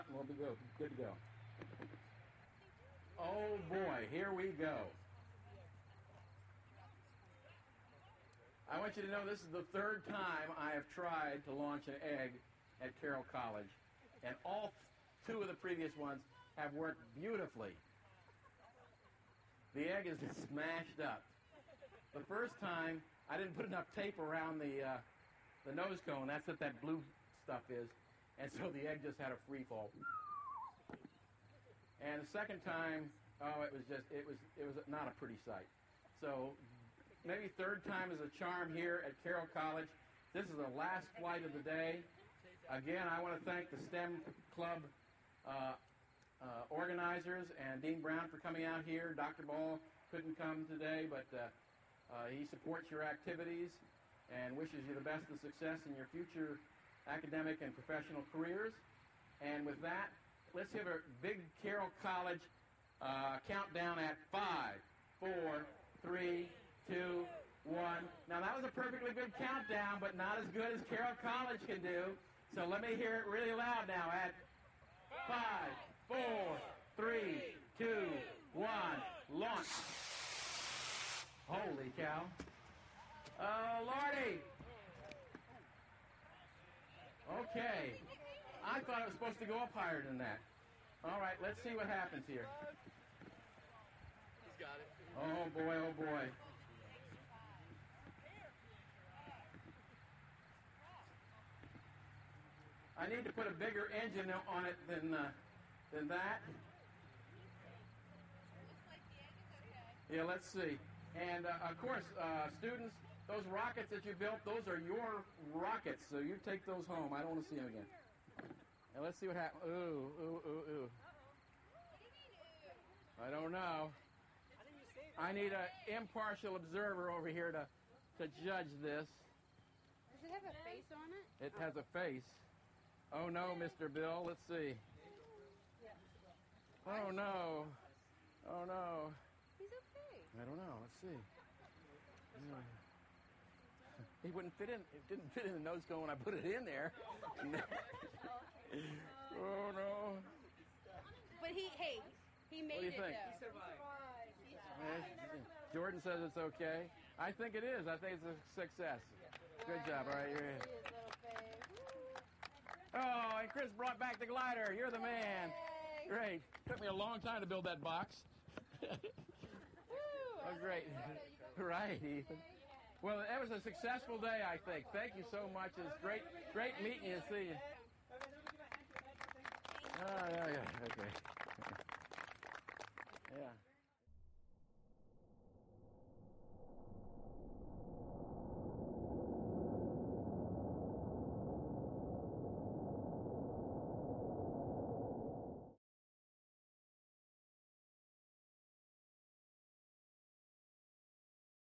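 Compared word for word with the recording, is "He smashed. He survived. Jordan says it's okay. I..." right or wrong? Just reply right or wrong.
wrong.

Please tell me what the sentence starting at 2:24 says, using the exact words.
It didn't fit in the nose cone when I put it in there.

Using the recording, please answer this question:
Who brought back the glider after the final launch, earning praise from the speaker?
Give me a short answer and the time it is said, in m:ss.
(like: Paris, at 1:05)
Chris, at 2:43.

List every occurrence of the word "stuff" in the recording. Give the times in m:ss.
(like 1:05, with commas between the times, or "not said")
0:27.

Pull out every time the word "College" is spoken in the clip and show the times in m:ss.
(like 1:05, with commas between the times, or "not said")
0:13, 0:39, 1:01, 1:11.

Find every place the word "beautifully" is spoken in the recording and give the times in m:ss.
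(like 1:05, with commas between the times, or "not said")
0:17.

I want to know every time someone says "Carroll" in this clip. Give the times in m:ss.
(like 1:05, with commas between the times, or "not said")
0:12, 0:39, 1:01, 1:10.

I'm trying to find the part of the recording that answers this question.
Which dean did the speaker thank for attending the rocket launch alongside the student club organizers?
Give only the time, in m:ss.
0:47.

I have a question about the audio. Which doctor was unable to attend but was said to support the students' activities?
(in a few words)
Dr. Ball.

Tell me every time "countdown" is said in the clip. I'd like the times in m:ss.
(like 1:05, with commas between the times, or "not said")
1:03, 1:09.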